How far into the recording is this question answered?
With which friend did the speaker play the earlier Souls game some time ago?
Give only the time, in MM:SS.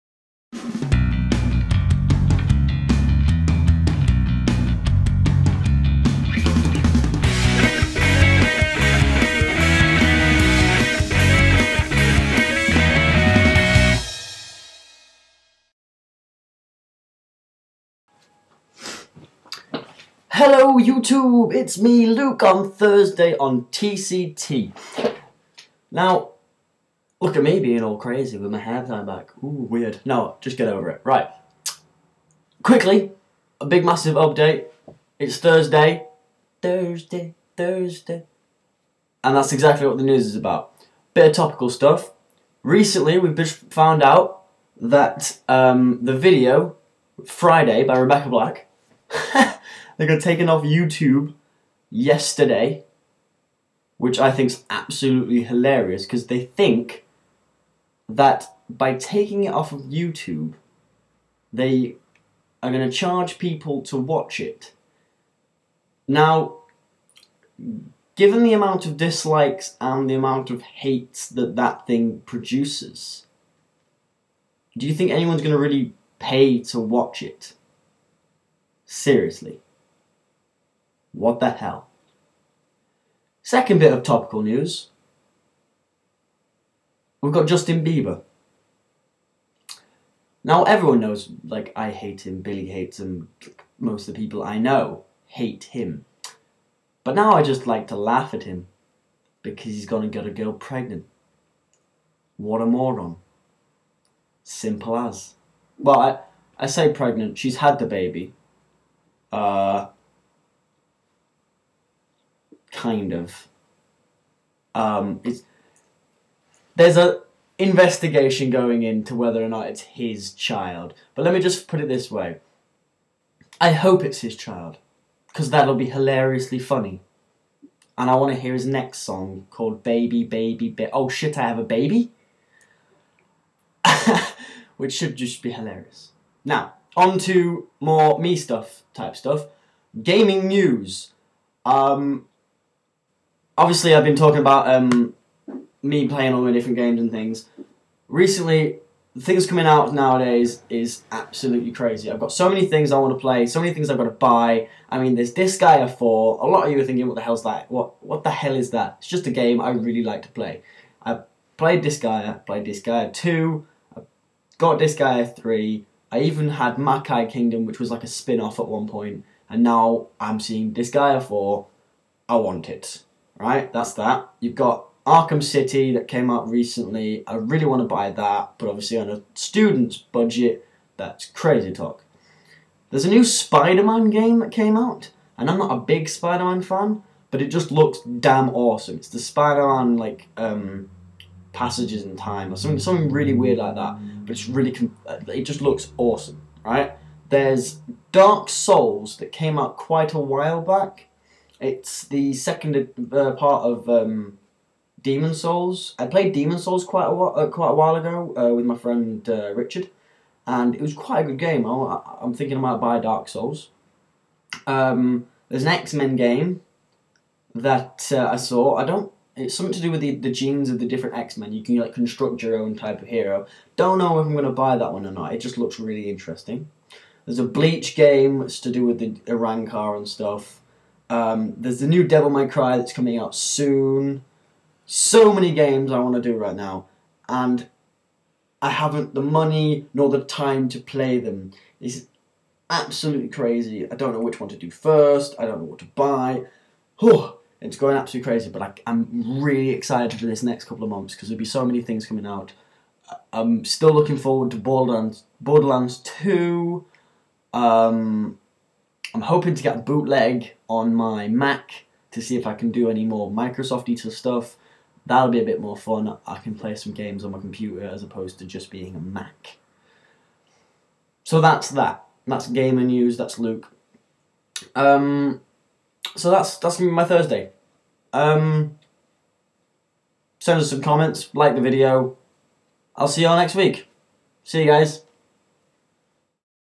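03:29.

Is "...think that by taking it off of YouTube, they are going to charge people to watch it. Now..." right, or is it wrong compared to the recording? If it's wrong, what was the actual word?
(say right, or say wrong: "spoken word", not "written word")
right.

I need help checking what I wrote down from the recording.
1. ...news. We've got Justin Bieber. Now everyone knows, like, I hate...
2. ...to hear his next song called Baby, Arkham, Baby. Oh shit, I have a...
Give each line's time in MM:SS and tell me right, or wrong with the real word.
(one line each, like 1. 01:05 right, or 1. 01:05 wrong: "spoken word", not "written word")
1. 01:24 right
2. 02:08 wrong: "Baby", not "Arkham".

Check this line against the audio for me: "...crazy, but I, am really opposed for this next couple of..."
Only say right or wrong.
wrong.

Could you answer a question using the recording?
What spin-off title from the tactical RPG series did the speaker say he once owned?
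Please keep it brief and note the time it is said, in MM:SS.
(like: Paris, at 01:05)
Makai Kingdom, at 02:46.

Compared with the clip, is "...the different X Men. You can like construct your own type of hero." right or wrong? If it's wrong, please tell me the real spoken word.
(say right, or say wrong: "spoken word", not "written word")
right.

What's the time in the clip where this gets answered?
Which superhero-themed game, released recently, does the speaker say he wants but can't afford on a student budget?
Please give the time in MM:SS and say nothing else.
02:55.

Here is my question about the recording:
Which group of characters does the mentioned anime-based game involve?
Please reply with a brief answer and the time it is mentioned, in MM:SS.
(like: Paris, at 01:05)
Arrancar, at 03:49.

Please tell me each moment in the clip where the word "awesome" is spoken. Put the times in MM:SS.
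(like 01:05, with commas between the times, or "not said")
03:08, 03:15.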